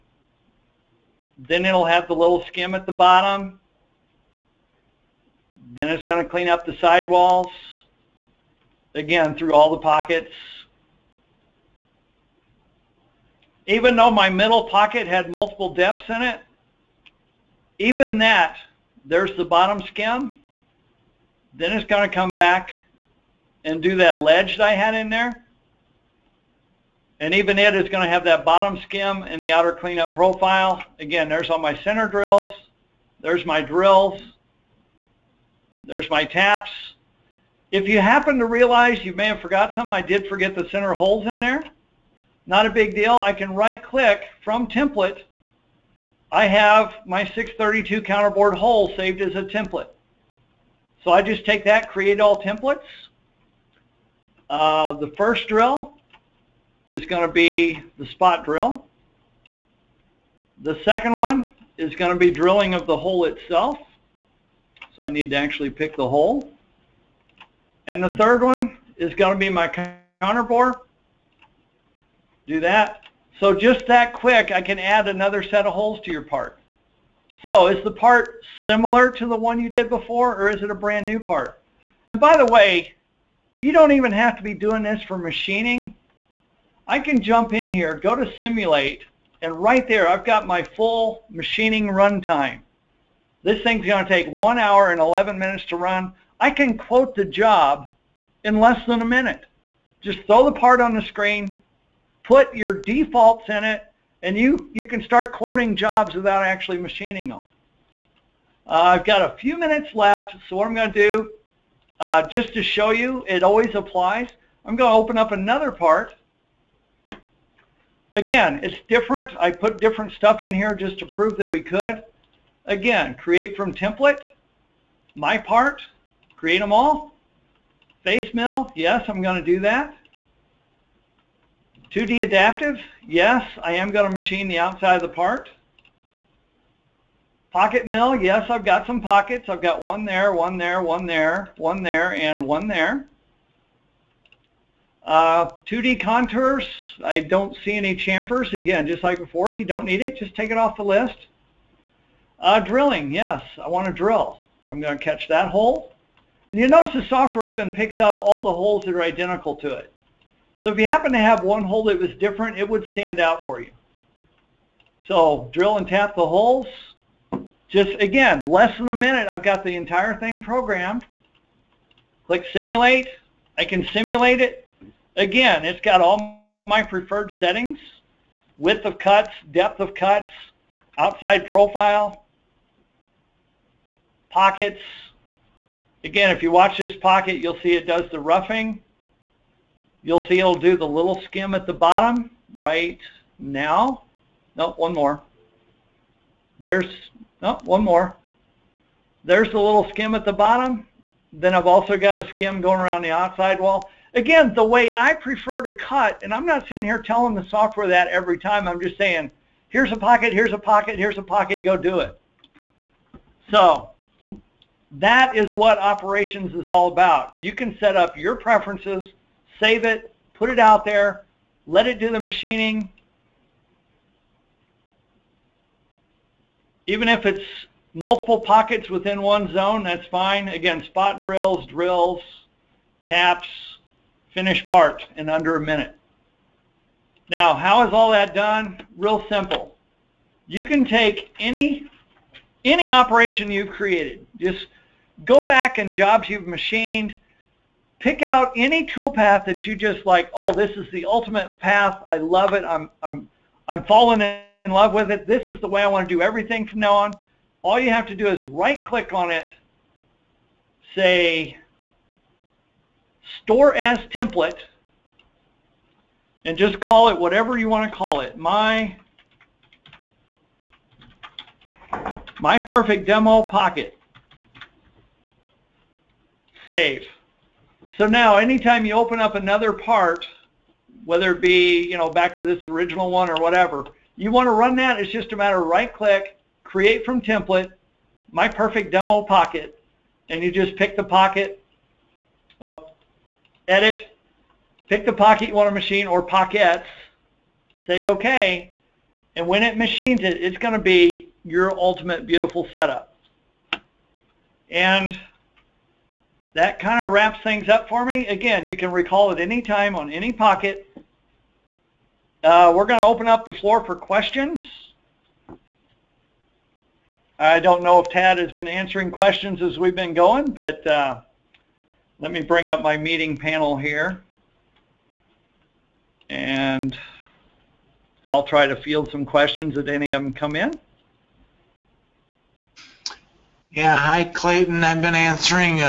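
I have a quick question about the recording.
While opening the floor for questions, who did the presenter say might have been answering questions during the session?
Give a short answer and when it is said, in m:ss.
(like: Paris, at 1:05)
Tad, at 5:18.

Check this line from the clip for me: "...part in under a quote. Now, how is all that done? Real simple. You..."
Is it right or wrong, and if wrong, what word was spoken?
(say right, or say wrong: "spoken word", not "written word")
wrong: "minute", not "quote".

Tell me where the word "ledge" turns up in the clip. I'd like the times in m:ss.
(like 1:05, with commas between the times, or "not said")
0:24.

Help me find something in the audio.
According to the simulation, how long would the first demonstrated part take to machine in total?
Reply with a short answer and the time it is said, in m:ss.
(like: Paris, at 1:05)
1 hour and 11 minutes, at 1:34.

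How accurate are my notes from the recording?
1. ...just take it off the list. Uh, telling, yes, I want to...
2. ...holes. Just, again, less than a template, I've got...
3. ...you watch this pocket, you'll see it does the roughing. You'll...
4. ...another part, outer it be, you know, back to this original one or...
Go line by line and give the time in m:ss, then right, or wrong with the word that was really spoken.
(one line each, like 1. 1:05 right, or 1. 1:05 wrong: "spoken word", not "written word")
1. 2:30 wrong: "drilling", not "telling"
2. 2:46 wrong: "minute", not "template"
3. 3:06 right
4. 4:39 wrong: "whether", not "outer".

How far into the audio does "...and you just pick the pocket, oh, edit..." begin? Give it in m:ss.
4:50.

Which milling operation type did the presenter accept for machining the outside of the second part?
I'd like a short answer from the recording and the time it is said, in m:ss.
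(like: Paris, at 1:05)
2D adaptive, at 2:11.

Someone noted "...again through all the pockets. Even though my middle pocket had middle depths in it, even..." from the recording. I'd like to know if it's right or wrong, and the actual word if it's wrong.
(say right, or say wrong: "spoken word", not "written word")
wrong: "multiple", not "middle".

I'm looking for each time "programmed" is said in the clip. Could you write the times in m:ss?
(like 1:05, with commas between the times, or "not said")
2:50.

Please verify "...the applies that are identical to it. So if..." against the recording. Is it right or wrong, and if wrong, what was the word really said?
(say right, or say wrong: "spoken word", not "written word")
wrong: "holes", not "applies".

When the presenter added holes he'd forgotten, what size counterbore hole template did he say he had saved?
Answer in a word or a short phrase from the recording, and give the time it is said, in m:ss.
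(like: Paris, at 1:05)
632, at 0:47.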